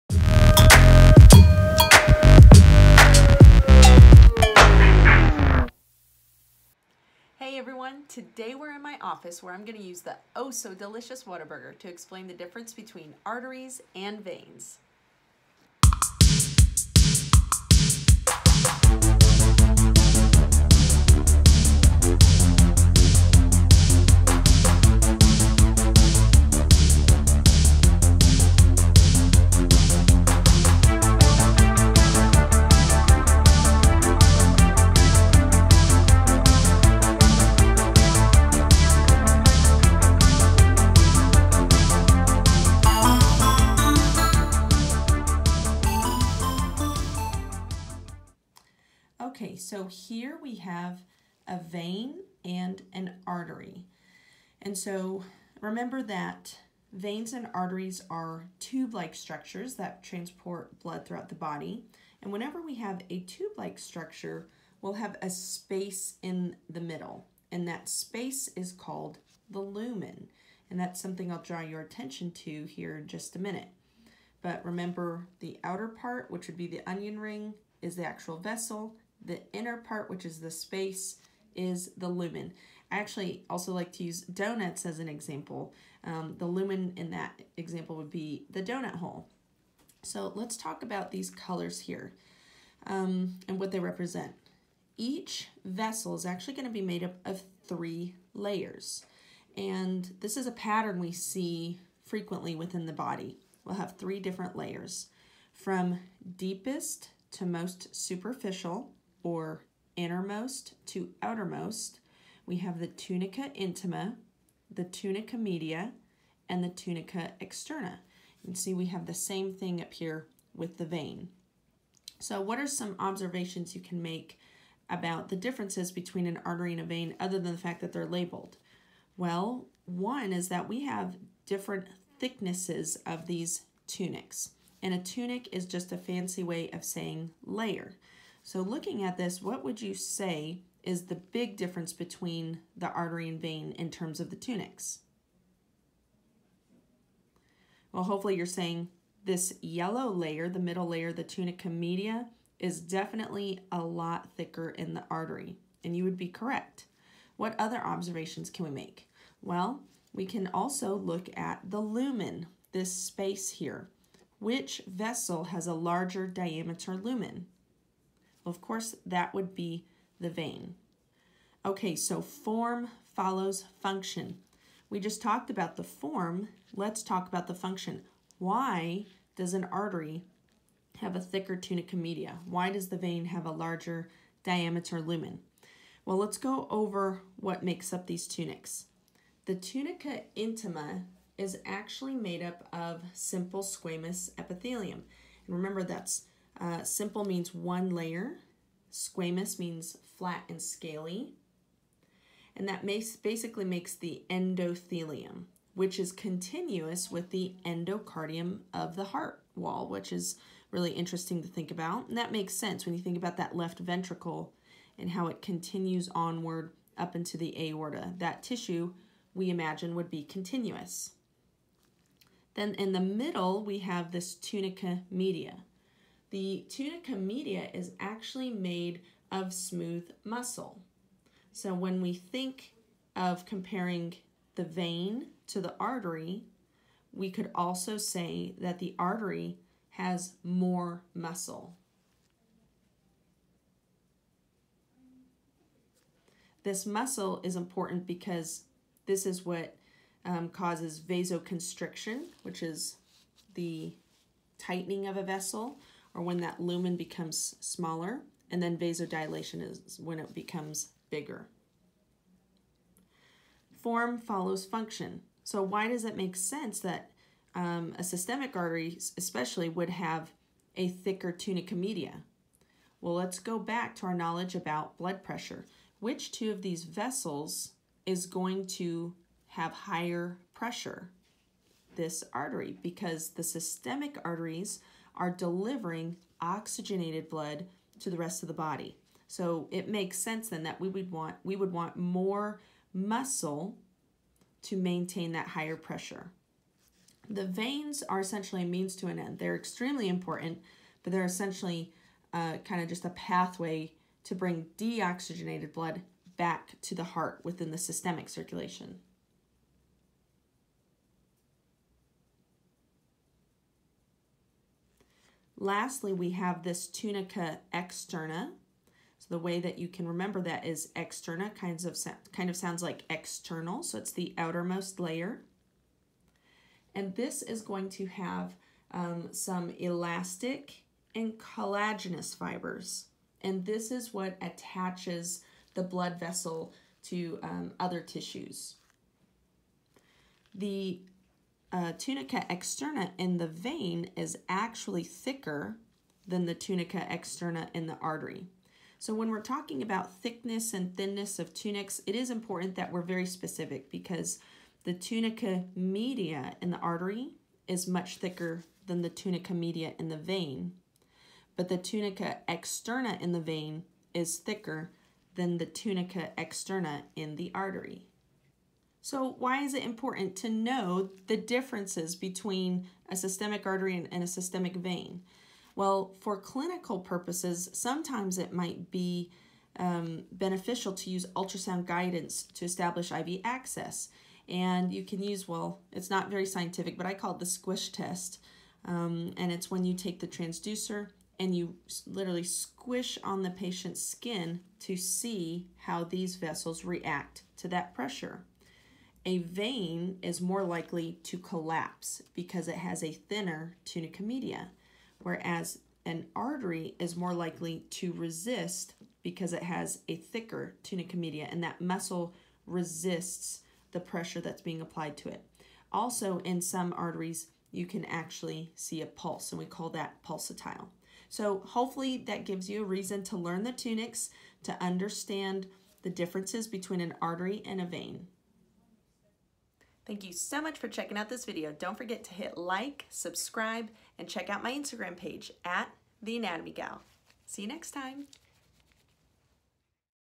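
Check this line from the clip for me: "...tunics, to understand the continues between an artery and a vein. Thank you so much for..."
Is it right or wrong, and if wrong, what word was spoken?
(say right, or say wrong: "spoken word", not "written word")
wrong: "differences", not "continues".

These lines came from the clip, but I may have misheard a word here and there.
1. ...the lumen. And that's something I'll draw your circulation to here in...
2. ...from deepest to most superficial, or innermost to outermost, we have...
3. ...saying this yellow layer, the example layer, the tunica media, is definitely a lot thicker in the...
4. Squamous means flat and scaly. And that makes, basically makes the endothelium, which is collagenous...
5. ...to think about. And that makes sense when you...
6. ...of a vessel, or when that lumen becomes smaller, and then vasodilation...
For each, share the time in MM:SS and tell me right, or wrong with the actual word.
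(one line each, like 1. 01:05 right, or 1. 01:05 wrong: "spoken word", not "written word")
1. 01:09 wrong: "attention", not "circulation"
2. 01:45 right
3. 02:28 wrong: "middle", not "example"
4. 03:18 wrong: "continuous", not "collagenous"
5. 03:31 right
6. 04:15 right.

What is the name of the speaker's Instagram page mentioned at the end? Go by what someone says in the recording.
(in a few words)
The Anatomy Gal.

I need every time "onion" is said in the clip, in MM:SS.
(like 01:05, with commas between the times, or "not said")
01:16.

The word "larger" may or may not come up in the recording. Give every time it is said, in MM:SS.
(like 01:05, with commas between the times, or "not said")
02:45, 03:03.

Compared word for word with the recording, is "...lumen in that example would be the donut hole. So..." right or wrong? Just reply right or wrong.
right.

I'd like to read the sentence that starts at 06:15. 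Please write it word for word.
Well, for clinical purposes, sometimes it might be um, beneficial to use ultrasound guidance to establish IV access.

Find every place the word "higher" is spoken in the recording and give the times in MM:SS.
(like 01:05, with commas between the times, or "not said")
04:39, 04:55.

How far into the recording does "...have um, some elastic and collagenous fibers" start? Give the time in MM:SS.
05:28.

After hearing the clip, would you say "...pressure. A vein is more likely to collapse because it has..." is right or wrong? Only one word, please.
right.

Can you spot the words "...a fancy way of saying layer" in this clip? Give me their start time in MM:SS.
02:15.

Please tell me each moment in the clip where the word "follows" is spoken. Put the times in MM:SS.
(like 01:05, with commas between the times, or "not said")
02:53, 04:24.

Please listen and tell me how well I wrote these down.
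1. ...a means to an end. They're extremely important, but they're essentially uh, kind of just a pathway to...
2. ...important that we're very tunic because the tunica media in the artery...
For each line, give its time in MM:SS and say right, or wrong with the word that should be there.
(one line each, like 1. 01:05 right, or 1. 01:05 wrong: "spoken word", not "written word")
1. 04:58 right
2. 05:52 wrong: "specific", not "tunic".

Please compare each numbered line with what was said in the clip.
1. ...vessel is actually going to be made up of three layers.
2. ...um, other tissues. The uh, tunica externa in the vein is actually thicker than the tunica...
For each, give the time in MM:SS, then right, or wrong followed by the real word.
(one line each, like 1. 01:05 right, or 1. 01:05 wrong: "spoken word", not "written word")
1. 01:35 right
2. 05:37 right.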